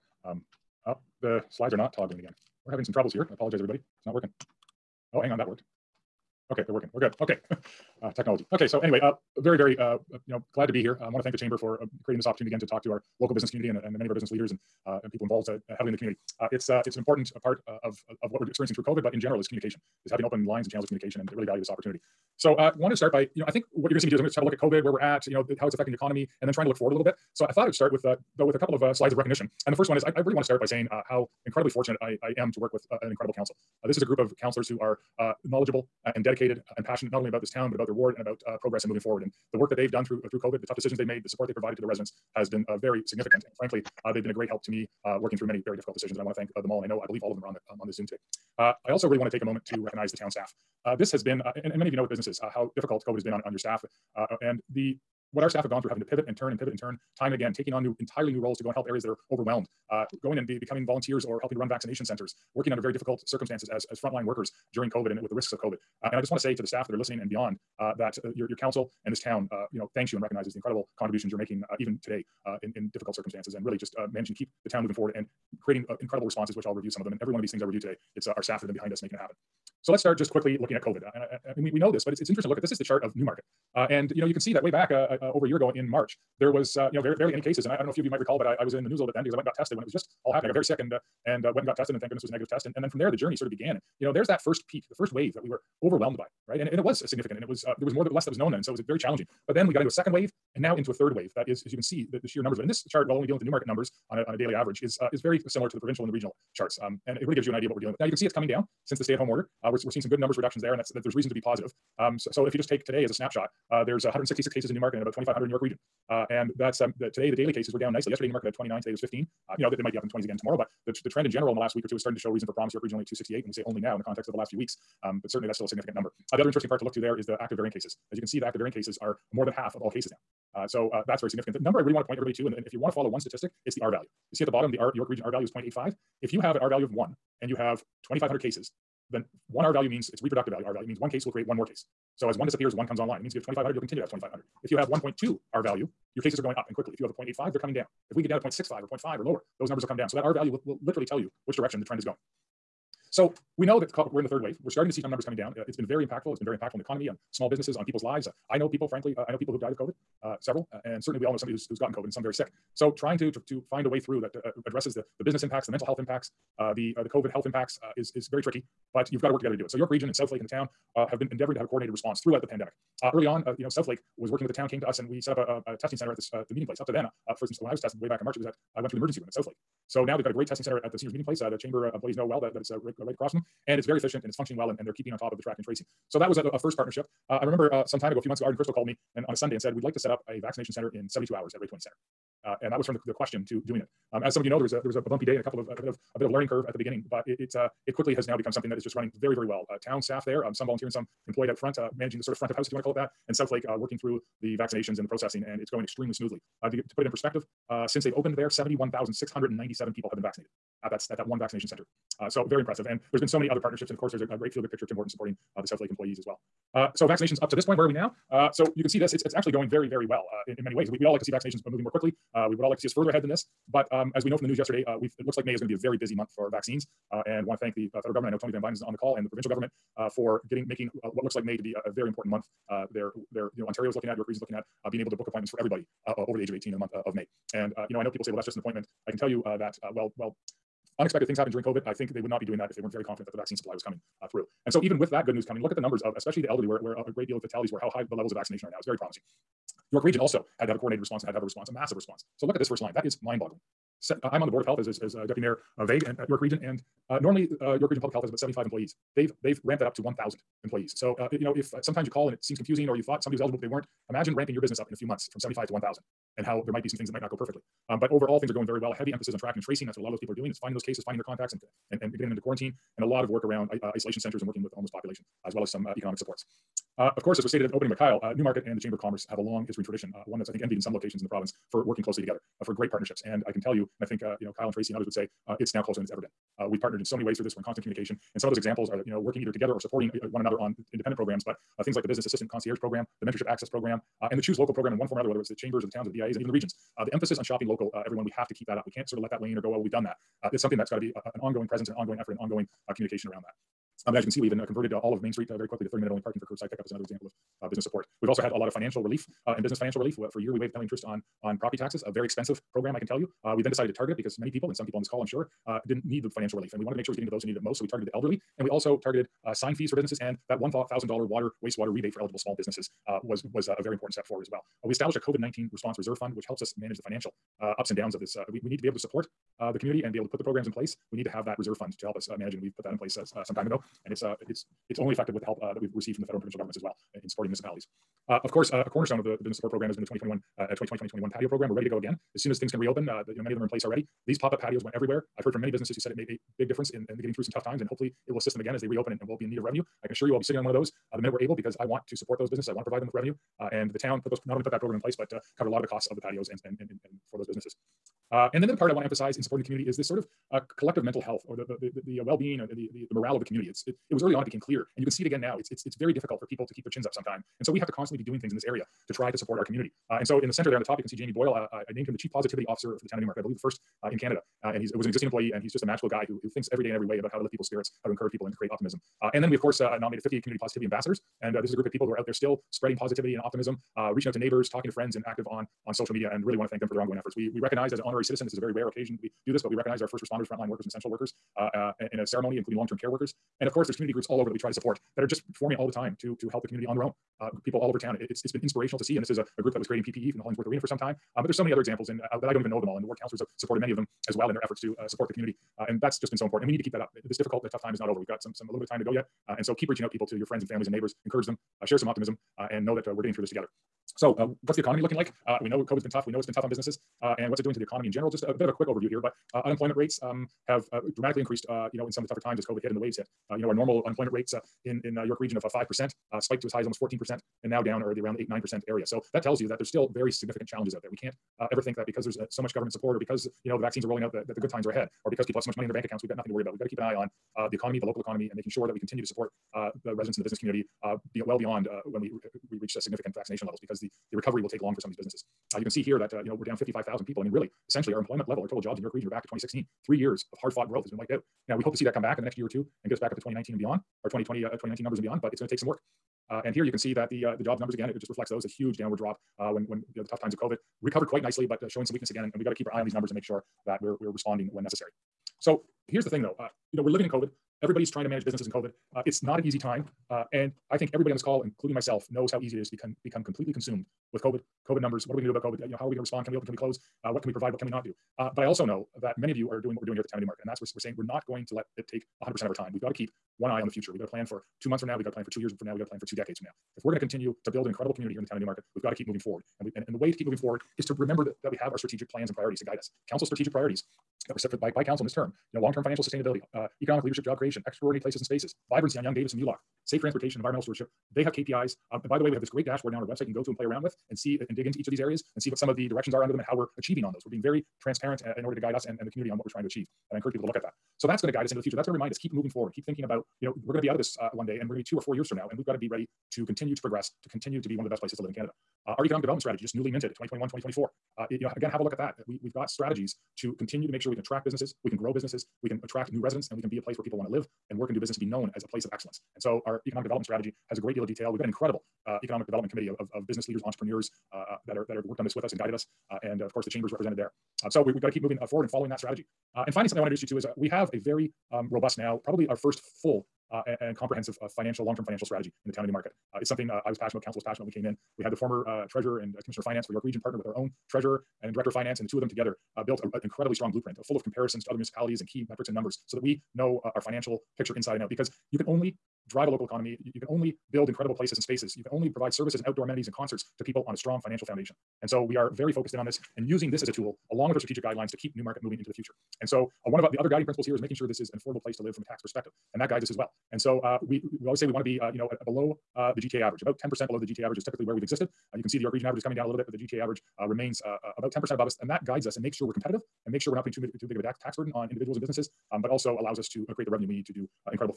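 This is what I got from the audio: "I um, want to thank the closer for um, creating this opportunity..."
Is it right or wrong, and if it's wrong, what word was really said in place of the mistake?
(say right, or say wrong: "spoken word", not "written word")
wrong: "chamber", not "closer".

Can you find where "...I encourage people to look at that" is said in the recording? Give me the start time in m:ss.
8:30.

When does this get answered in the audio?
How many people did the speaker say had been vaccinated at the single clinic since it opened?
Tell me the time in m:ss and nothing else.
3:28.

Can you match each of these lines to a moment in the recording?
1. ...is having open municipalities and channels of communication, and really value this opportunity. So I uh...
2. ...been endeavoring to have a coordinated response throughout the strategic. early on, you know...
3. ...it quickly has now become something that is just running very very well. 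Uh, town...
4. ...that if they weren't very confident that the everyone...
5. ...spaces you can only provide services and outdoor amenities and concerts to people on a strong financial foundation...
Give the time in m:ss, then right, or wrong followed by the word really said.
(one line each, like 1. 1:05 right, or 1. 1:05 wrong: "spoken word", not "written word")
1. 0:20 wrong: "lines", not "municipalities"
2. 2:51 wrong: "pandemic", not "strategic"
3. 3:17 right
4. 4:02 wrong: "vaccine", not "everyone"
5. 9:21 right.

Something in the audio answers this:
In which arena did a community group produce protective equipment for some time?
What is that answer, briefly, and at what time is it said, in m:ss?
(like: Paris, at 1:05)
Hollingsworth Arena, at 6:40.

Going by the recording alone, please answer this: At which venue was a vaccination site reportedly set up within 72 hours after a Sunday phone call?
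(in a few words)
Ray Twinney Center.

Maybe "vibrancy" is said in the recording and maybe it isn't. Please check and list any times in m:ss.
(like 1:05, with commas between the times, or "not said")
8:18.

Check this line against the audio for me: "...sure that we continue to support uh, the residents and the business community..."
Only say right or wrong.
right.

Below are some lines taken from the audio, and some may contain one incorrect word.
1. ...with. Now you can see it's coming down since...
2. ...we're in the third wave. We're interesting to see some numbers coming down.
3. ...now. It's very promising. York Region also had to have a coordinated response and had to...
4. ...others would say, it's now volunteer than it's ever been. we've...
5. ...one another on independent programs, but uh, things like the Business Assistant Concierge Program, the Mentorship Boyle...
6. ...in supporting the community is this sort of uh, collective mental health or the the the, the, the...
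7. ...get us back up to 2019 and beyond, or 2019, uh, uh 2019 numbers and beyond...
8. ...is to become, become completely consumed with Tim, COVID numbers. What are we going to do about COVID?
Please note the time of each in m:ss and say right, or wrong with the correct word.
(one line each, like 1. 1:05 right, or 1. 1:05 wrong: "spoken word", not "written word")
1. 1:47 right
2. 2:34 wrong: "starting", not "interesting"
3. 4:08 right
4. 4:44 wrong: "closer", not "volunteer"
5. 4:50 wrong: "Access", not "Boyle"
6. 5:59 right
7. 7:33 wrong: "2020", not "2019"
8. 7:52 wrong: "COVID", not "Tim".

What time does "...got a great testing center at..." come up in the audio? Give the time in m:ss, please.
3:00.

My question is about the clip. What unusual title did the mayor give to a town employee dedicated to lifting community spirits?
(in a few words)
Chief Positivity Officer.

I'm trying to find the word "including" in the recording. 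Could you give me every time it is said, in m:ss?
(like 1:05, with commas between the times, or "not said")
6:32, 7:51.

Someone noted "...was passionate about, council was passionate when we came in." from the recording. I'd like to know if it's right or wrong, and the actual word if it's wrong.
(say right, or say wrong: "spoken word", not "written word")
right.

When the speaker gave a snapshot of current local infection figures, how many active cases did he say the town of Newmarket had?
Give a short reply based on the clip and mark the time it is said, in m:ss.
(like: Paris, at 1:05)
166, at 1:54.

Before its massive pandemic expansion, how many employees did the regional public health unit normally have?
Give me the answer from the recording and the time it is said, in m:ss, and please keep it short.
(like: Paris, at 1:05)
75, at 4:18.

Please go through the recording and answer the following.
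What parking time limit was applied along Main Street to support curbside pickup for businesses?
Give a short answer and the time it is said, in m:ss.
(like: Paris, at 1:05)
30 minutes, at 5:05.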